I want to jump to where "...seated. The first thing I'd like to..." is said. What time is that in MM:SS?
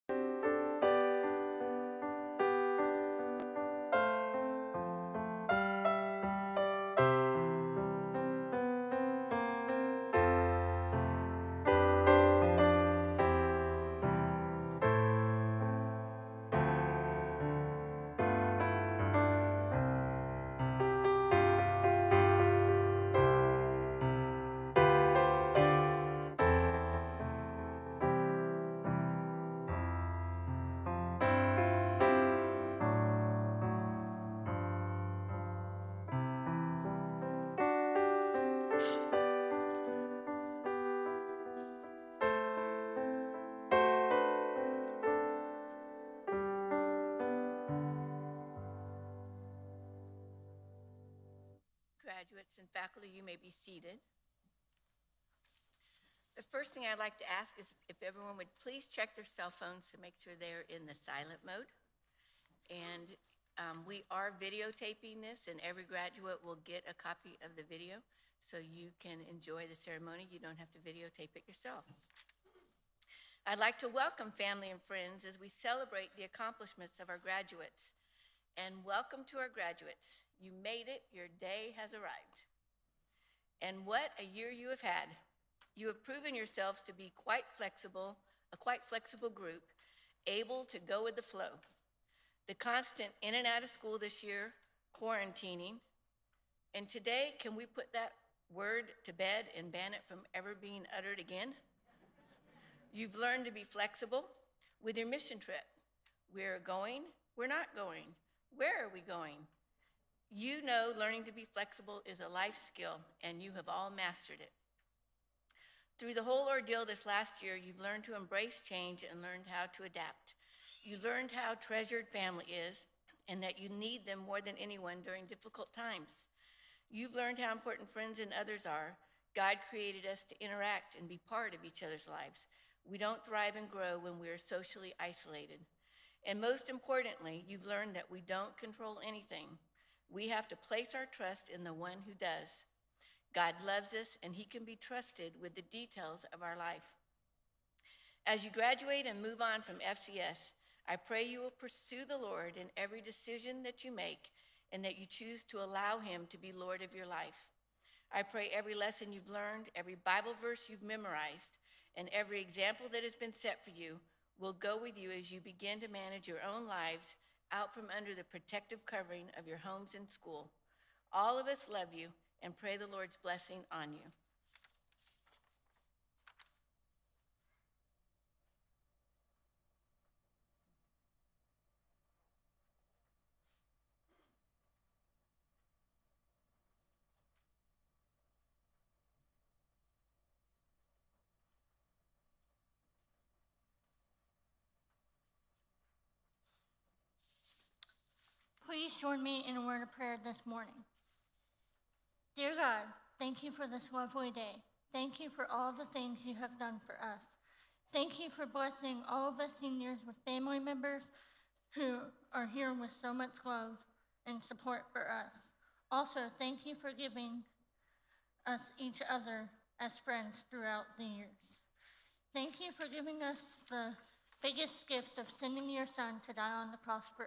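00:53.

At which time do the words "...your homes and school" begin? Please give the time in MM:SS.
02:49.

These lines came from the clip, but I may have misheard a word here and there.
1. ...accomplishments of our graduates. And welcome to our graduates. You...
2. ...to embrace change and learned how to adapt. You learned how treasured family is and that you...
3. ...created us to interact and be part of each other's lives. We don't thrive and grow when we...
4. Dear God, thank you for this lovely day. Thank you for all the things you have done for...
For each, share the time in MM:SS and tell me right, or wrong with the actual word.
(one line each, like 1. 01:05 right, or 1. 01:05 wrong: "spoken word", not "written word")
1. 01:16 right
2. 01:58 right
3. 02:09 right
4. 03:22 right.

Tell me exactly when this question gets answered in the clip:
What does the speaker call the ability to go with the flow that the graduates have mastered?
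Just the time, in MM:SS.
01:52.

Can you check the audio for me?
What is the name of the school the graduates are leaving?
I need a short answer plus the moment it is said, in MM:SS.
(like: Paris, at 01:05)
FCS, at 02:29.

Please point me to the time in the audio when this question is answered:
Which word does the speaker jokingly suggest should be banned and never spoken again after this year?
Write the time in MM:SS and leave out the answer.
01:35.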